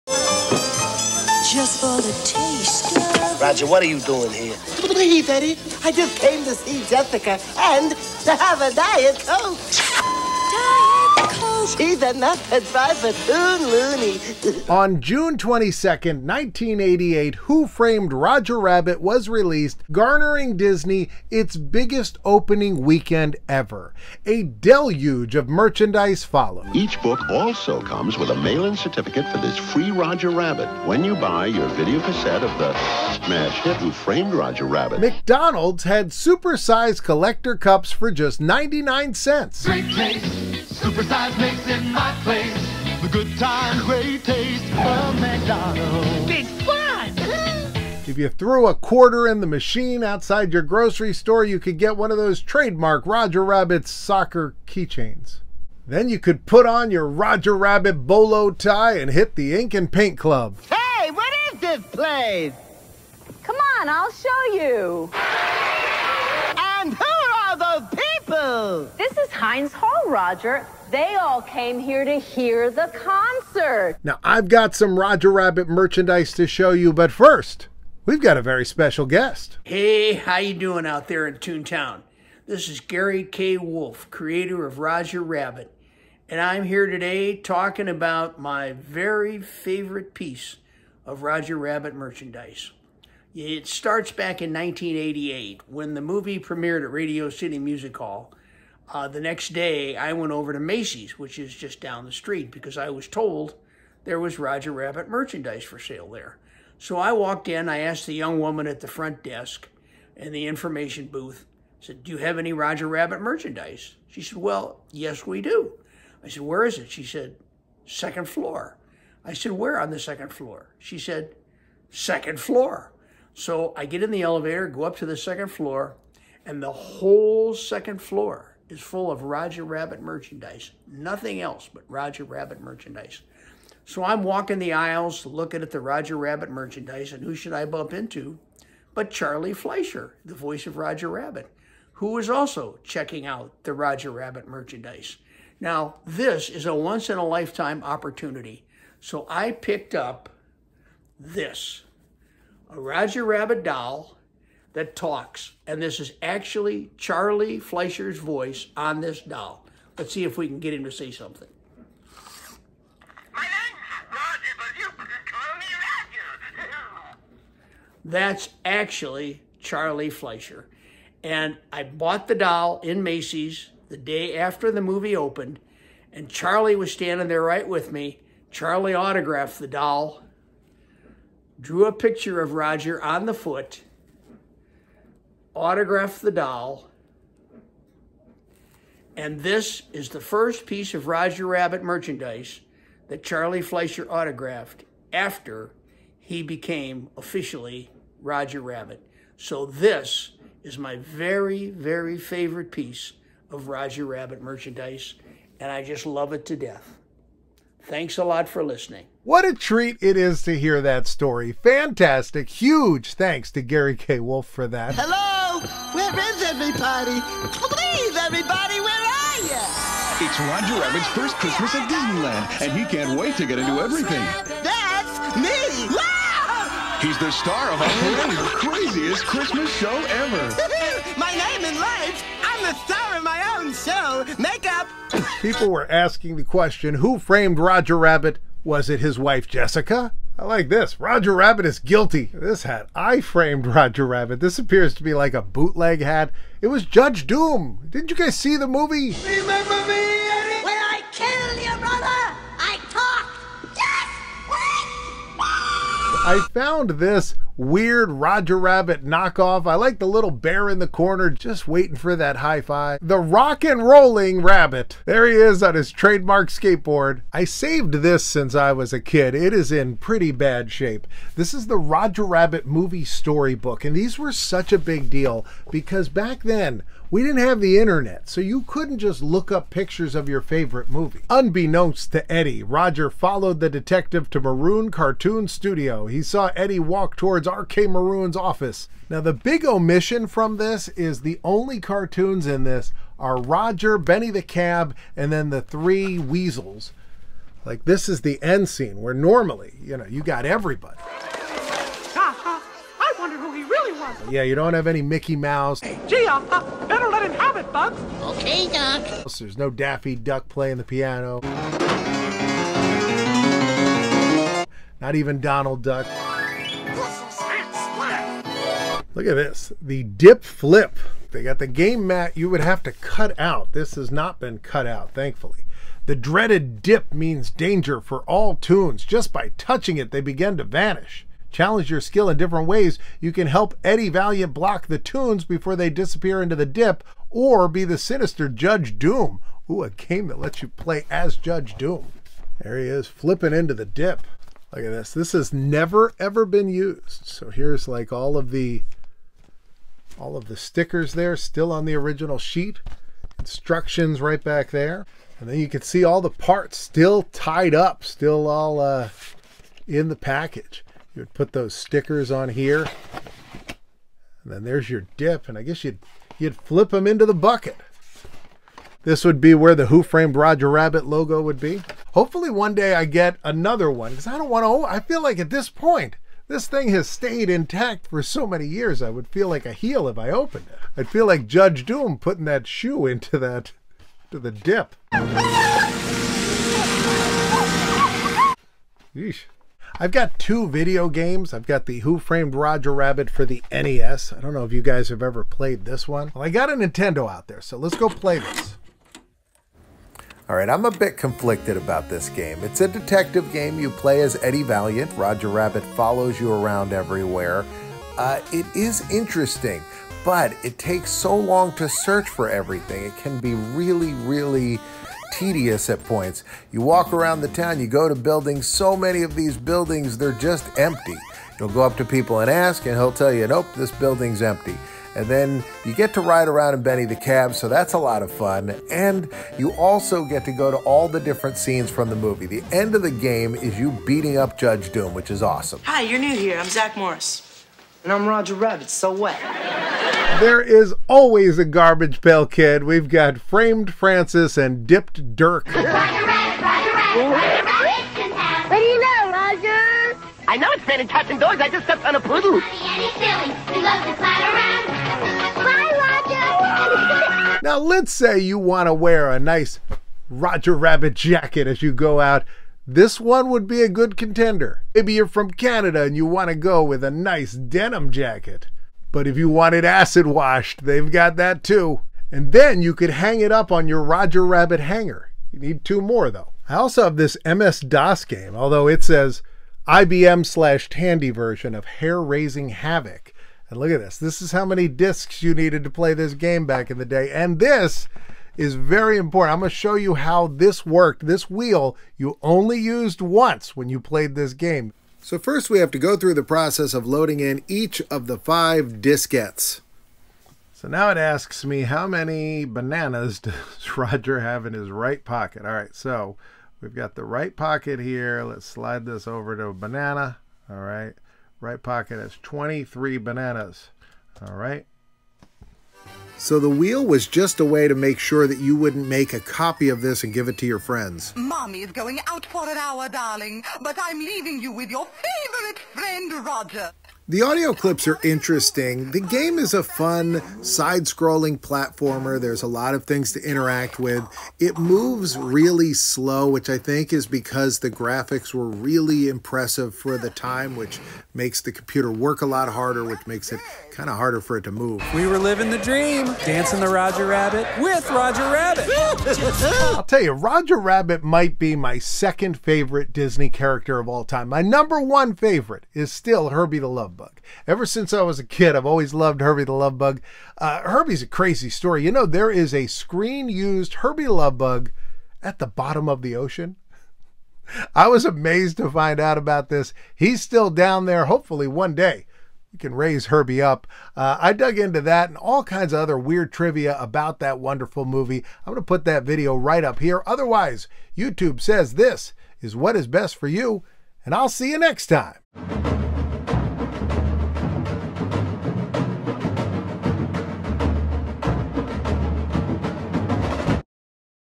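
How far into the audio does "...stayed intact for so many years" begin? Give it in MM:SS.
06:17.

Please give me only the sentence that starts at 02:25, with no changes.
Now, this is a once-in-a-lifetime opportunity.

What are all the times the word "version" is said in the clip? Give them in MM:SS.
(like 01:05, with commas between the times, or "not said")
08:01.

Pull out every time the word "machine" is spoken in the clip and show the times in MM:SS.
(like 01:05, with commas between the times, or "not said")
00:49.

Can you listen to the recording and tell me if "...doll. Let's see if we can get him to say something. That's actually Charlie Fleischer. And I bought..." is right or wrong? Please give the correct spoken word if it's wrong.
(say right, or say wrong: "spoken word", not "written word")
right.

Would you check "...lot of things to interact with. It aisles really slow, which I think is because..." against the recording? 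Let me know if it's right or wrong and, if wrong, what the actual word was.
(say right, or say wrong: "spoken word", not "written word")
wrong: "moves", not "aisles".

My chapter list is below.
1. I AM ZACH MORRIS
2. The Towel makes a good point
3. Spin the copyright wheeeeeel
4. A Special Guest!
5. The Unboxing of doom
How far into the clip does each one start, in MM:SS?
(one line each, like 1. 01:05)
1. 07:16
2. 04:00
3. 08:32
4. 01:18
5. 05:36.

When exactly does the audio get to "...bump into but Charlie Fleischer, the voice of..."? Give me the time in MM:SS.
02:17.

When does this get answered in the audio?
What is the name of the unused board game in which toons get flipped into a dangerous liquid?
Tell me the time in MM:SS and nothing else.
05:19.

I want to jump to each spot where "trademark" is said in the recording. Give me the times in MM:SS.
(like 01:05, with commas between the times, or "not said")
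00:52, 04:25.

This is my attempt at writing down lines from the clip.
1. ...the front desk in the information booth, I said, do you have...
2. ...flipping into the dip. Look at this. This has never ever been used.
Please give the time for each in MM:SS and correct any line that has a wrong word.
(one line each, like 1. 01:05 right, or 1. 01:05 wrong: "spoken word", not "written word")
1. 01:48 right
2. 05:43 right.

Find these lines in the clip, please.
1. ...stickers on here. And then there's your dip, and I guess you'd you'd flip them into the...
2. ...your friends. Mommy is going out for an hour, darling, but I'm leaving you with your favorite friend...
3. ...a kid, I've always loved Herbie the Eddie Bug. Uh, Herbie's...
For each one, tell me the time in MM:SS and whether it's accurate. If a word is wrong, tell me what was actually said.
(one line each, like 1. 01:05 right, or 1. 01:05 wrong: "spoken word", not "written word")
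1. 06:01 right
2. 08:40 right
3. 09:18 wrong: "Love", not "Eddie".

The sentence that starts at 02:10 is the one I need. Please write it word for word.
Nothing else but Roger Rabbit merchandise.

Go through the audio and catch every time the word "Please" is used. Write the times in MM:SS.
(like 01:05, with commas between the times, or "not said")
00:04, 03:37.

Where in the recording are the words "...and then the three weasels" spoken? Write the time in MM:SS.
04:55.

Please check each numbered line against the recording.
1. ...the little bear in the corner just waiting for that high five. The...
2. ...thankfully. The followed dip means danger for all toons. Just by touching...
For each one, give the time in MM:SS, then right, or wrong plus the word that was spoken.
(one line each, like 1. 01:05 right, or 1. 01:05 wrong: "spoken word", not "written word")
1. 04:19 right
2. 05:25 wrong: "dreaded", not "followed".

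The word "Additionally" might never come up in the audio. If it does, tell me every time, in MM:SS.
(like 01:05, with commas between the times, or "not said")
not said.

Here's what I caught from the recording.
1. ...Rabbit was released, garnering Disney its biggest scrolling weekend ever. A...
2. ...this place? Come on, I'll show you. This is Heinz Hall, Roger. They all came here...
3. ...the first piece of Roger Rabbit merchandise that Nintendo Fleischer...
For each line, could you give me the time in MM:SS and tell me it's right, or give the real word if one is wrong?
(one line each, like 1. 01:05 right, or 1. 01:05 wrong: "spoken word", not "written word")
1. 00:18 wrong: "opening", not "scrolling"
2. 01:01 right
3. 03:10 wrong: "Charlie", not "Nintendo".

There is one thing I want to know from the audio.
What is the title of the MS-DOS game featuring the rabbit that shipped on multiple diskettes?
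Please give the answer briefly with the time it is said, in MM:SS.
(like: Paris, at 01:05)
Hare Raising Havoc, at 08:01.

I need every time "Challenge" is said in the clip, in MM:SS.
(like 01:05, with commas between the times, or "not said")
05:31.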